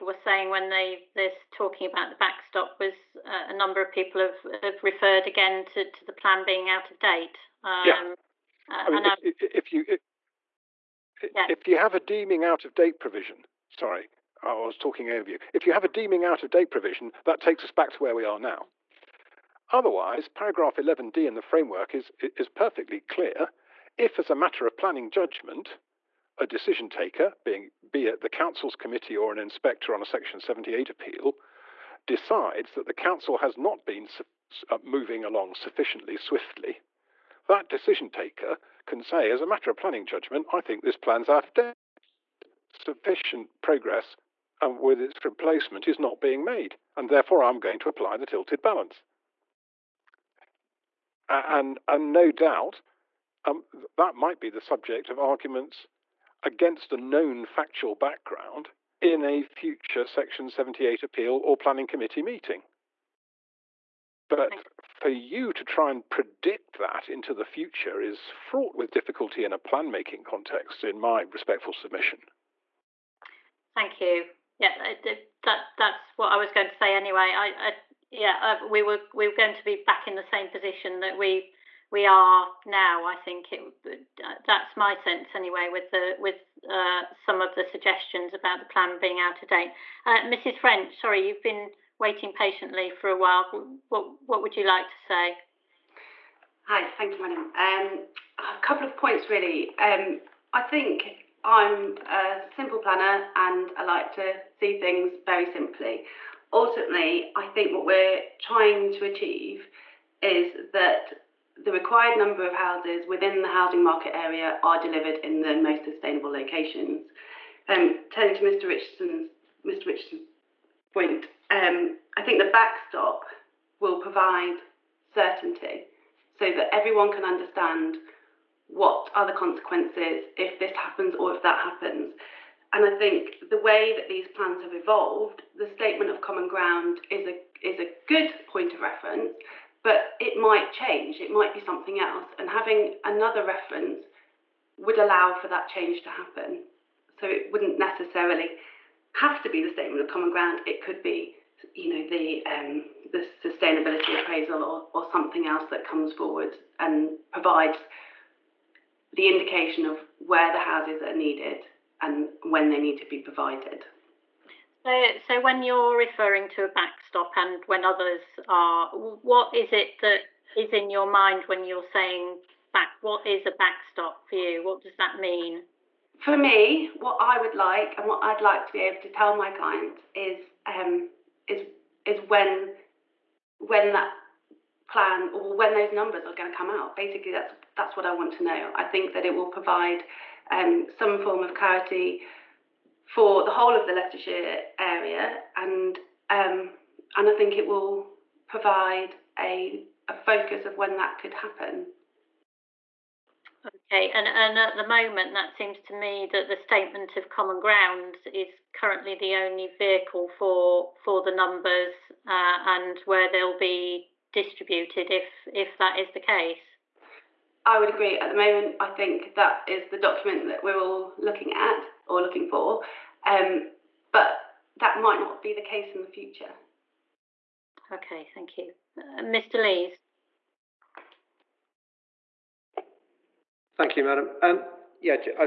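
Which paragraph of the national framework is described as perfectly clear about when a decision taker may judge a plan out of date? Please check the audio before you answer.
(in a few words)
Paragraph 11D.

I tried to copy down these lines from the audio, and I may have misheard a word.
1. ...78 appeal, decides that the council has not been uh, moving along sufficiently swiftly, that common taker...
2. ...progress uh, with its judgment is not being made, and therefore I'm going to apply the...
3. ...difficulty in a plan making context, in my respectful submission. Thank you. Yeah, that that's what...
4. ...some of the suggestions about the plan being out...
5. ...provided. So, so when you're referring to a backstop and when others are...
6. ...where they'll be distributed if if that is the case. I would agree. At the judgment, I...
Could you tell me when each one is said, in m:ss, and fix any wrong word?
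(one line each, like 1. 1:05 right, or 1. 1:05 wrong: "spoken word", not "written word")
1. 0:30 wrong: "decision", not "common"
2. 0:43 wrong: "replacement", not "judgment"
3. 1:08 right
4. 1:27 right
5. 2:43 right
6. 3:33 wrong: "moment", not "judgment".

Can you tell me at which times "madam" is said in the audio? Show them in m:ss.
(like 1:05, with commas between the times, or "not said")
1:37, 3:54.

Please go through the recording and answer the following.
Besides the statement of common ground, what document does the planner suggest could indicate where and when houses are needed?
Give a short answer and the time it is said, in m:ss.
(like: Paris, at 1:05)
Sustainability appraisal, at 2:33.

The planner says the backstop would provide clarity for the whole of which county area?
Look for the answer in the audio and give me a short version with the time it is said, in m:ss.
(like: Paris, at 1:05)
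Leicestershire, at 3:13.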